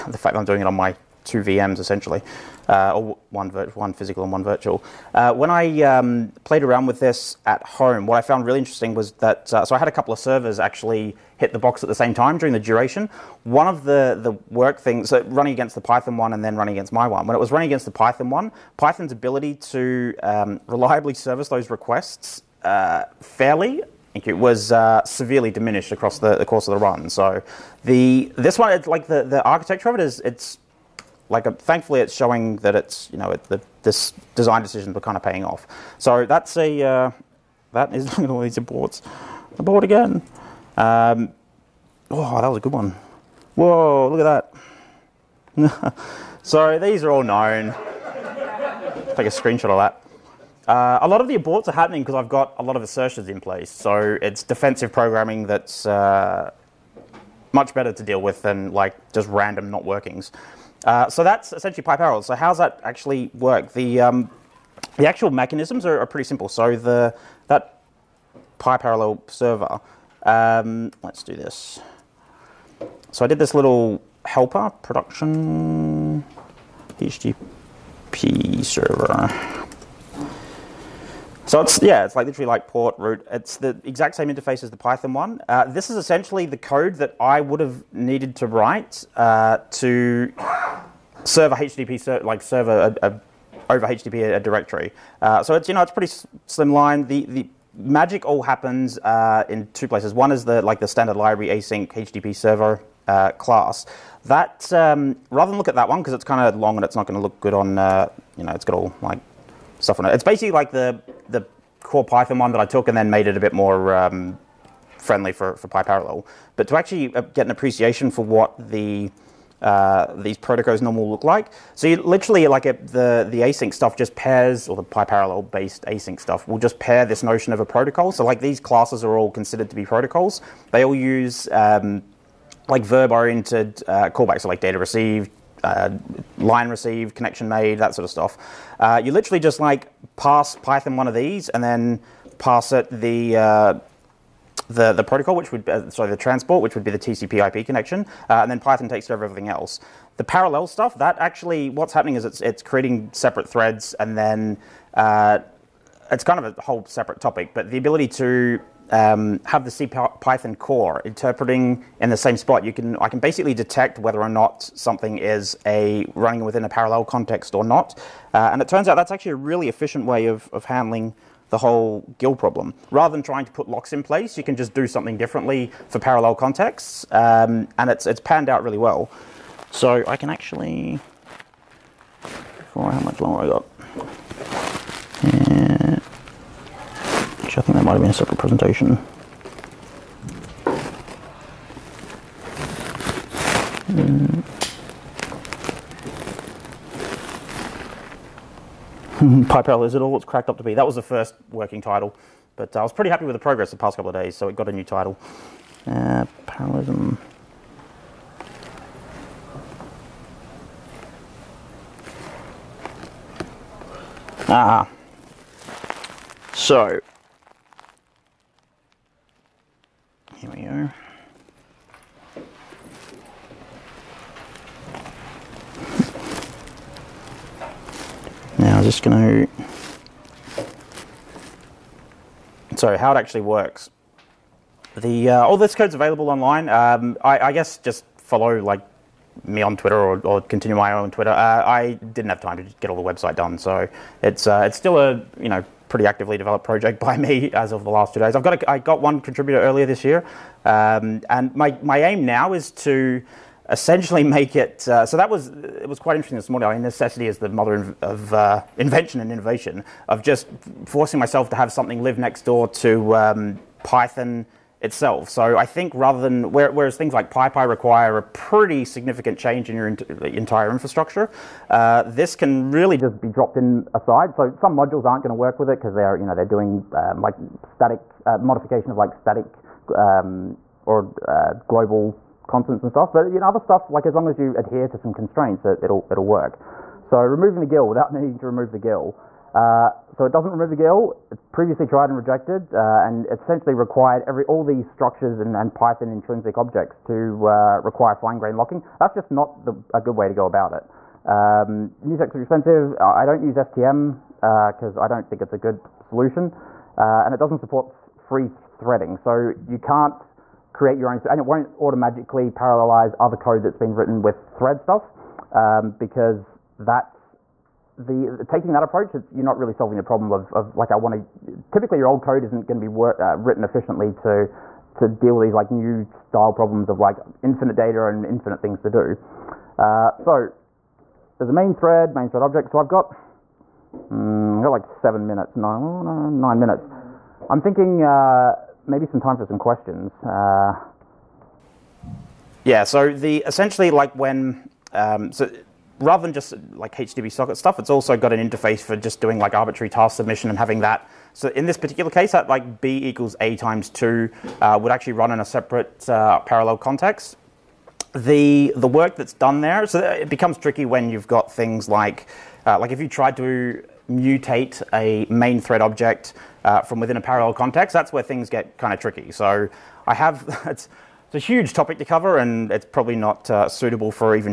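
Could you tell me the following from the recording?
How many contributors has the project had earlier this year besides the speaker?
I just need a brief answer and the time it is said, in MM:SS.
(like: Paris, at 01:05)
1, at 04:09.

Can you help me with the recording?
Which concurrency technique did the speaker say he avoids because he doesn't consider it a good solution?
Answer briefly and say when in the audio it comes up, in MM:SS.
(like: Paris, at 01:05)
STM, at 05:03.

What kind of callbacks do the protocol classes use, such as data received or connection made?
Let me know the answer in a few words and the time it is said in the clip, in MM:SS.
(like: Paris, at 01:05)
verb oriented, at 02:12.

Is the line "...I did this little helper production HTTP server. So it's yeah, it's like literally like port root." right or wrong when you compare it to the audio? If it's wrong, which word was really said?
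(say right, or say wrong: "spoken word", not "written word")
right.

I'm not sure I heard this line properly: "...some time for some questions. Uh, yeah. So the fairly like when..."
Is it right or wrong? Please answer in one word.
wrong.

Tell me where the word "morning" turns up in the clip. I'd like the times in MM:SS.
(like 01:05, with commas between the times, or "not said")
04:16.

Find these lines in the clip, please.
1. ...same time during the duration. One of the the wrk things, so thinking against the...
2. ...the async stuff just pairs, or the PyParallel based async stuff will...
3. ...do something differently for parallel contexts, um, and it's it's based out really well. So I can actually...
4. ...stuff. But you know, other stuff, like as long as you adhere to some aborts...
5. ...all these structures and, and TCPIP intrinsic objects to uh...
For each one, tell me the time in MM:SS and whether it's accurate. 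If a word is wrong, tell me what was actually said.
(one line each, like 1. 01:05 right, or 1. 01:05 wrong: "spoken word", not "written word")
1. 00:11 wrong: "running", not "thinking"
2. 02:03 right
3. 02:54 wrong: "panned", not "based"
4. 04:42 wrong: "constraints", not "aborts"
5. 04:54 wrong: "Python", not "TCPIP".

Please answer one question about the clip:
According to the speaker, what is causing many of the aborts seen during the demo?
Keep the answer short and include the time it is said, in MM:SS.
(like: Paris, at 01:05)
assertions, at 00:52.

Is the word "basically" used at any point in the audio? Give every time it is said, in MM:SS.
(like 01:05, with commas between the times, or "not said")
01:50, 02:43.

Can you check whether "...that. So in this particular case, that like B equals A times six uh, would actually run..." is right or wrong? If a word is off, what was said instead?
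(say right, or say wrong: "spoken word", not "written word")
wrong: "two", not "six".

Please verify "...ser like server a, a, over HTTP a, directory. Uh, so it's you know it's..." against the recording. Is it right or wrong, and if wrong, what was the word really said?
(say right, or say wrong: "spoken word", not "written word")
right.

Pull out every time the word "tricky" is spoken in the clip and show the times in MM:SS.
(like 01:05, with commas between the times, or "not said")
06:00, 06:08.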